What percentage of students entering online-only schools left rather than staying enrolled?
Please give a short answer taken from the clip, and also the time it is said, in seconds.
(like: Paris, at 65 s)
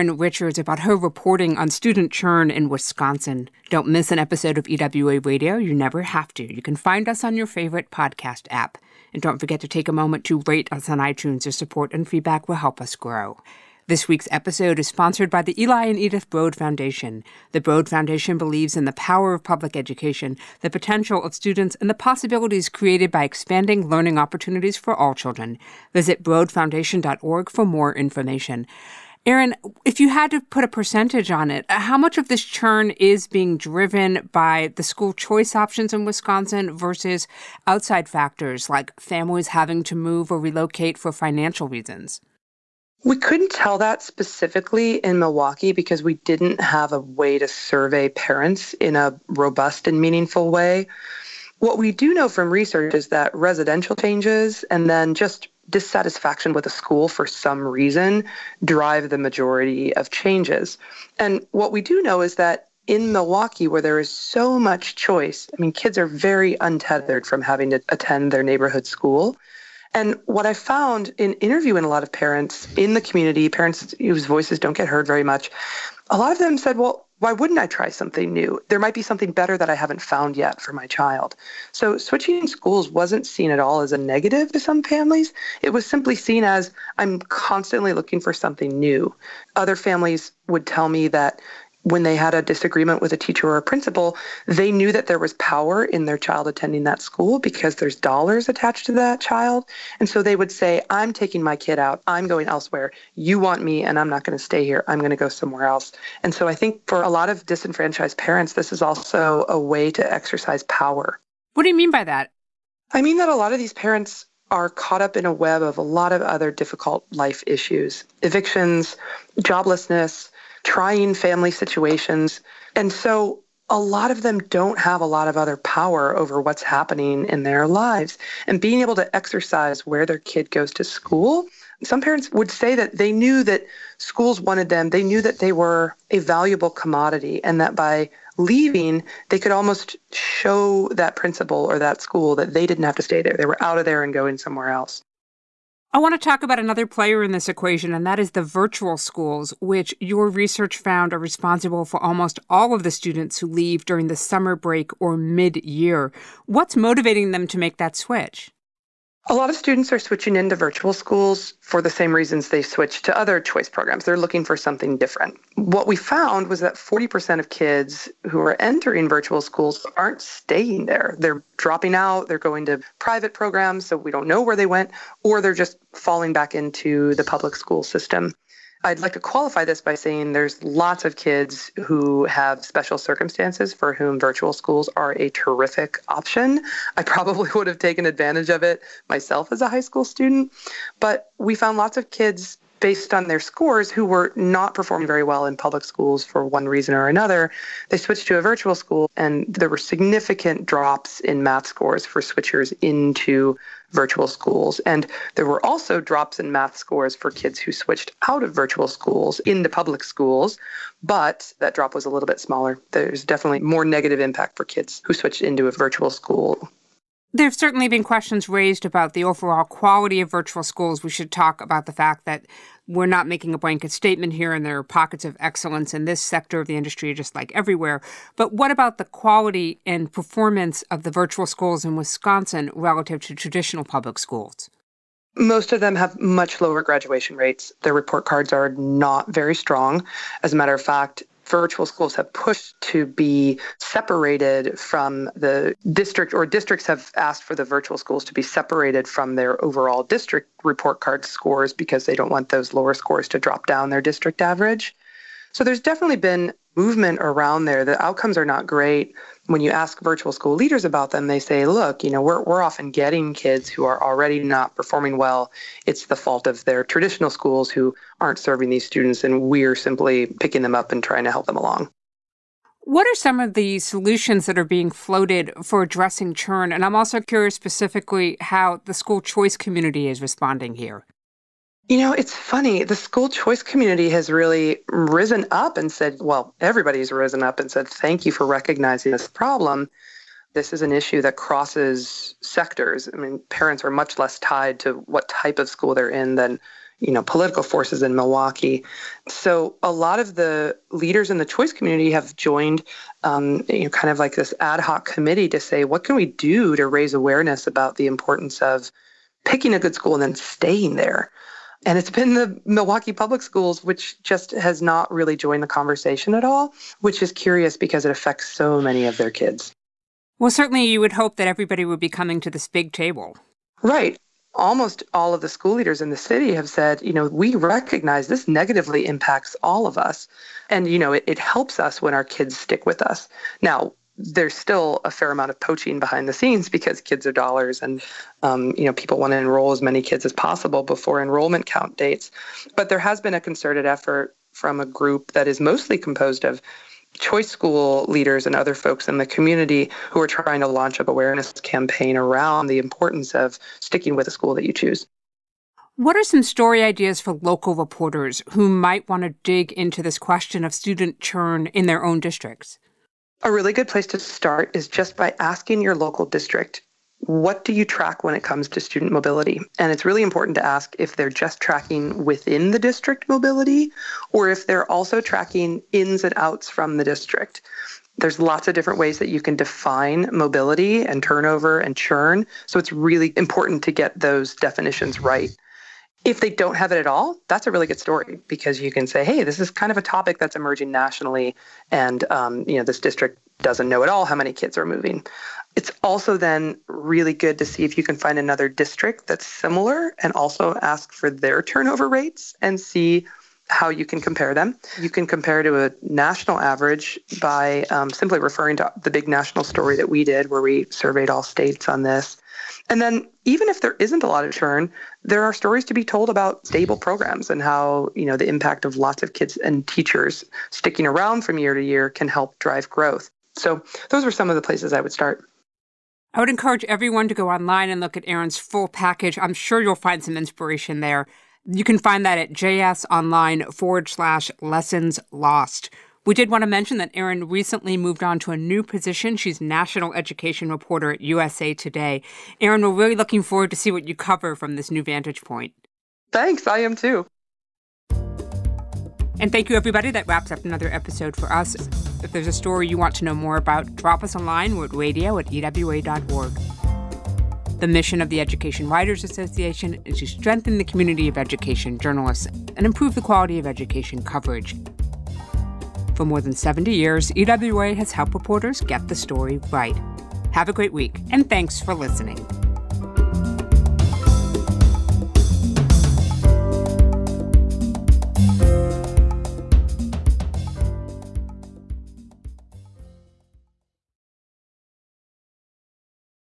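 40%, at 166 s.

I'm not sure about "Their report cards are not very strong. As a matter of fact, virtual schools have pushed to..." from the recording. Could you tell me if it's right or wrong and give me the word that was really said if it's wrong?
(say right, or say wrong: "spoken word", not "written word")
right.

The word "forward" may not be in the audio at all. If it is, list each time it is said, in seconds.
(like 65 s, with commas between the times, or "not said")
433 s, 443 s.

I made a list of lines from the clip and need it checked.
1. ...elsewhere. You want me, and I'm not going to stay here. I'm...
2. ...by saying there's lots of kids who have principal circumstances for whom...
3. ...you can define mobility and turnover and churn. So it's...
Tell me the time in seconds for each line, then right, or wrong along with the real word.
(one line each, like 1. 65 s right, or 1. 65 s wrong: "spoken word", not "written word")
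1. 102 s right
2. 179 s wrong: "special", not "principal"
3. 379 s right.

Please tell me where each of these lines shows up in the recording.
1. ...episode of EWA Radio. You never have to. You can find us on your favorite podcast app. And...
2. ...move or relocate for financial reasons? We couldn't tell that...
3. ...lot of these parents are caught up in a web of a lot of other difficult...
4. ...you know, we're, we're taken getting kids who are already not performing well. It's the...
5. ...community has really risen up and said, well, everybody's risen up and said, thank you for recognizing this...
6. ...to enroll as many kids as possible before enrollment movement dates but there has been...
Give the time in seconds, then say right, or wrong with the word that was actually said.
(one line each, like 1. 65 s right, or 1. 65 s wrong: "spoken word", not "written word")
1. 4 s right
2. 39 s right
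3. 113 s right
4. 262 s wrong: "often", not "taken"
5. 283 s right
6. 339 s wrong: "count", not "movement".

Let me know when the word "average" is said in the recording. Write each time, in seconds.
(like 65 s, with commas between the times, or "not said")
254 s, 406 s.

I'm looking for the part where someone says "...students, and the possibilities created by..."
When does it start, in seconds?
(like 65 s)
21 s.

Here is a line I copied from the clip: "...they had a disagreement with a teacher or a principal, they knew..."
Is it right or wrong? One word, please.
right.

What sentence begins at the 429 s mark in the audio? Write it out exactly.
I'm sure you'll find some inspiration there.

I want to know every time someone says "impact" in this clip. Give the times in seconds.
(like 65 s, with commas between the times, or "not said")
214 s, 329 s, 418 s.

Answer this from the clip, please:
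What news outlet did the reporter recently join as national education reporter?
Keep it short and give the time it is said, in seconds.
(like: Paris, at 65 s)
USA Today, at 441 s.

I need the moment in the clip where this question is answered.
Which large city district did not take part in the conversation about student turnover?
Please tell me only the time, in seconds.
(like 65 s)
312 s.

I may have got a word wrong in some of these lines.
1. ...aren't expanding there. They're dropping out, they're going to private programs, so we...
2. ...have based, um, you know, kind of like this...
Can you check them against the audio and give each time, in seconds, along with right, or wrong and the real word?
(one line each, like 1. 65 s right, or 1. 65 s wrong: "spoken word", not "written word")
1. 169 s wrong: "staying", not "expanding"
2. 302 s wrong: "joined", not "based".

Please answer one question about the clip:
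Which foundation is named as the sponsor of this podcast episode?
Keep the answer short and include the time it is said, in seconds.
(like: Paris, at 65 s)
Eli and Edith Broad Foundation, at 15 s.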